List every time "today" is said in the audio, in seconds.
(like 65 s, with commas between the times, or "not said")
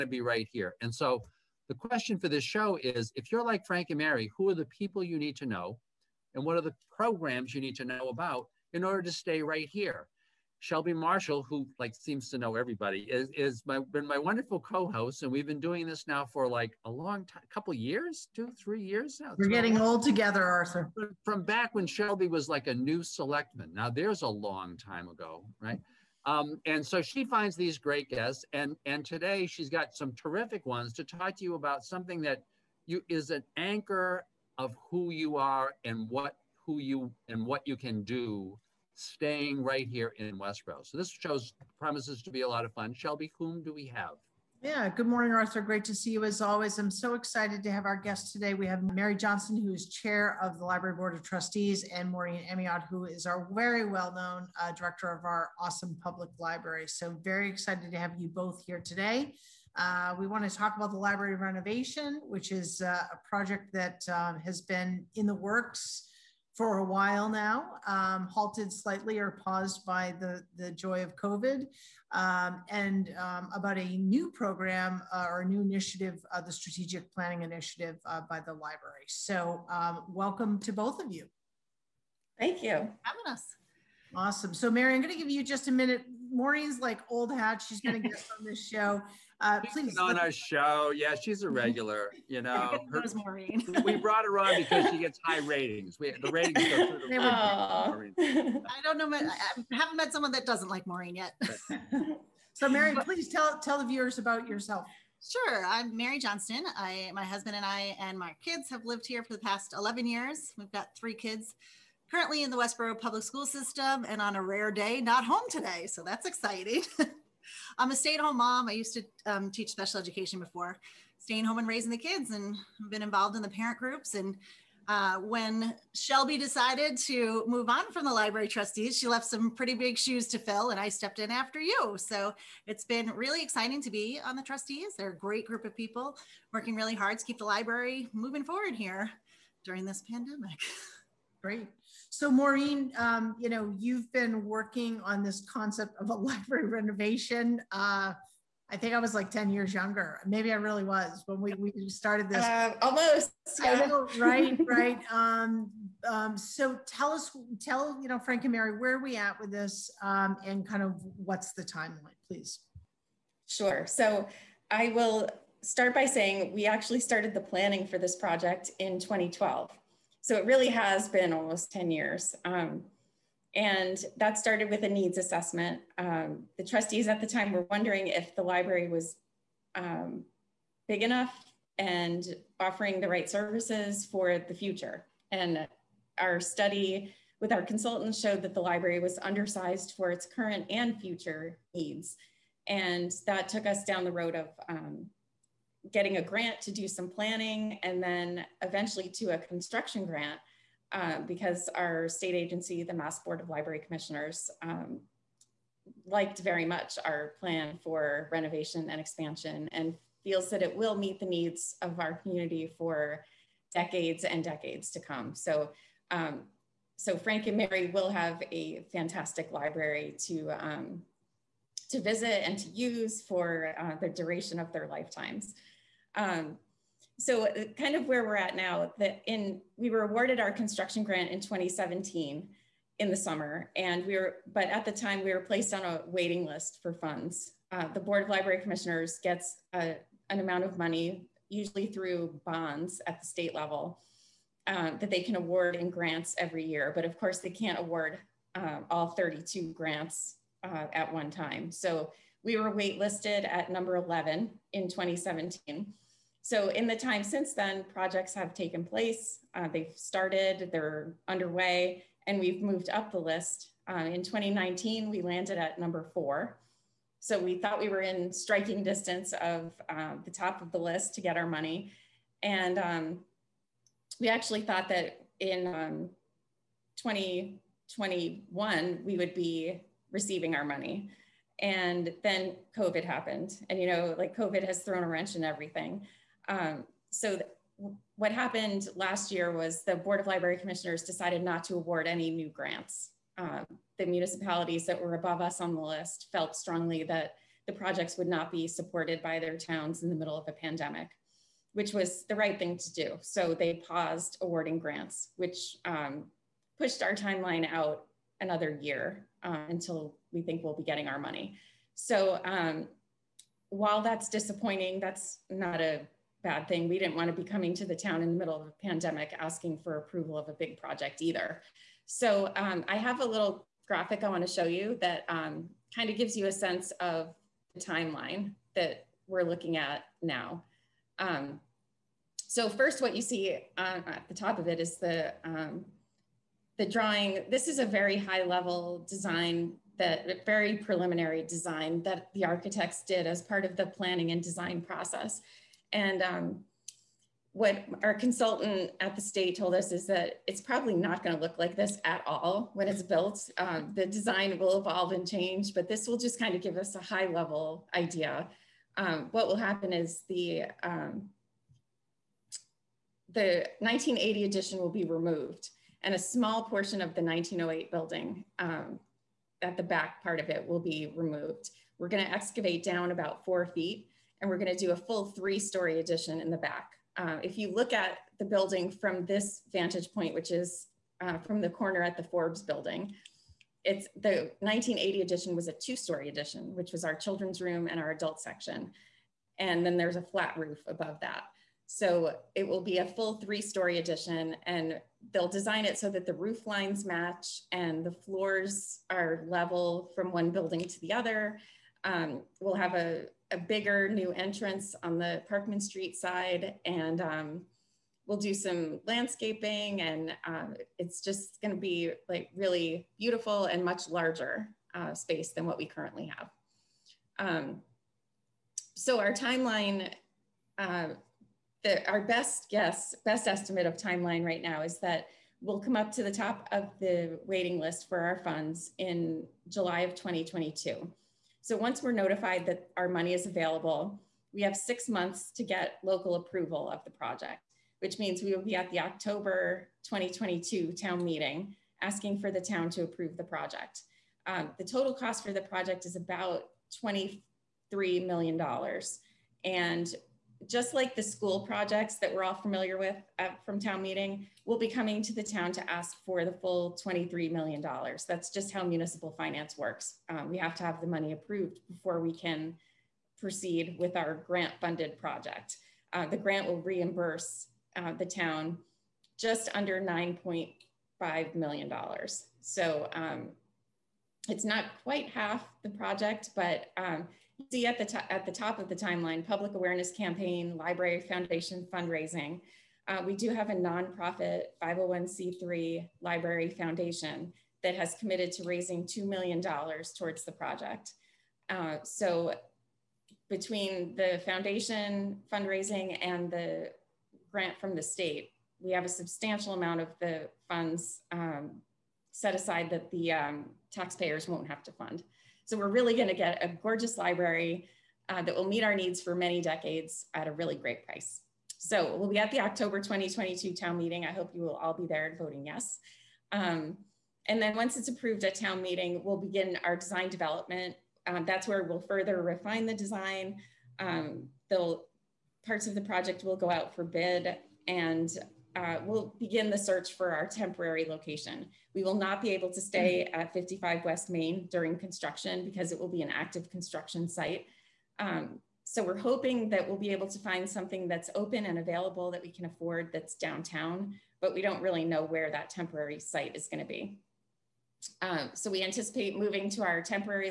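29 s, 48 s, 58 s, 115 s.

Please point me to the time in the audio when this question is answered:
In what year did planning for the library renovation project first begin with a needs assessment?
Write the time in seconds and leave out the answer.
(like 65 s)
168 s.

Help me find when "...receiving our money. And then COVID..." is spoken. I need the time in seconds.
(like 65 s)
280 s.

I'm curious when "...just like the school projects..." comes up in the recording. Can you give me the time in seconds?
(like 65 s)
450 s.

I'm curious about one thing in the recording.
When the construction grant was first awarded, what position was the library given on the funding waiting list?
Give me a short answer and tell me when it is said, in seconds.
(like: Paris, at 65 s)
11, at 253 s.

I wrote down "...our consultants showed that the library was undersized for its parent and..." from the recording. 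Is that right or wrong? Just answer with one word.
wrong.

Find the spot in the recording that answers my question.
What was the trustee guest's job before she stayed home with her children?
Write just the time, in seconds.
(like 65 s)
119 s.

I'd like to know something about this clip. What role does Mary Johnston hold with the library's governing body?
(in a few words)
Chair of the Library Board of Trustees.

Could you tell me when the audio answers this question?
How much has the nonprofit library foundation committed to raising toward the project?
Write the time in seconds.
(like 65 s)
489 s.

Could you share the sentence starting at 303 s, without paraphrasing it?
So they paused awarding grants, which um, pushed our timeline out another year uh, until we think we'll be getting our money.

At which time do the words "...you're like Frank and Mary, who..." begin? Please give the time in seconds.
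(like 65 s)
3 s.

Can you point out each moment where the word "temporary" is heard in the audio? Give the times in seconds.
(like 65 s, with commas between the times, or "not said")
530 s, 545 s.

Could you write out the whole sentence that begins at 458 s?
That's just how municipal finance works.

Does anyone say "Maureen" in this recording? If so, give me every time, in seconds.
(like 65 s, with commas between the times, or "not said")
52 s, 86 s, 93 s, 100 s, 142 s.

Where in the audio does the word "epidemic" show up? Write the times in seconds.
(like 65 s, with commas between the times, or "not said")
not said.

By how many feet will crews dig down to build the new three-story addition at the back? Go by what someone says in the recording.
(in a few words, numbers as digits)
4.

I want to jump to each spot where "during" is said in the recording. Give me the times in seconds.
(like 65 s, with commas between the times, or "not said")
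139 s, 534 s.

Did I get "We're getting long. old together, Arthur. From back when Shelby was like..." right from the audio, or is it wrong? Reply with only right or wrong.
right.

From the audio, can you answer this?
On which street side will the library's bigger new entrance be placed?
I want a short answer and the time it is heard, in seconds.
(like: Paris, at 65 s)
Parkman Street, at 405 s.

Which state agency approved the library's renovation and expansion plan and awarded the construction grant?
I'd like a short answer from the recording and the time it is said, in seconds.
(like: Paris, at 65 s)
Mass Board of Library Commissioners, at 202 s.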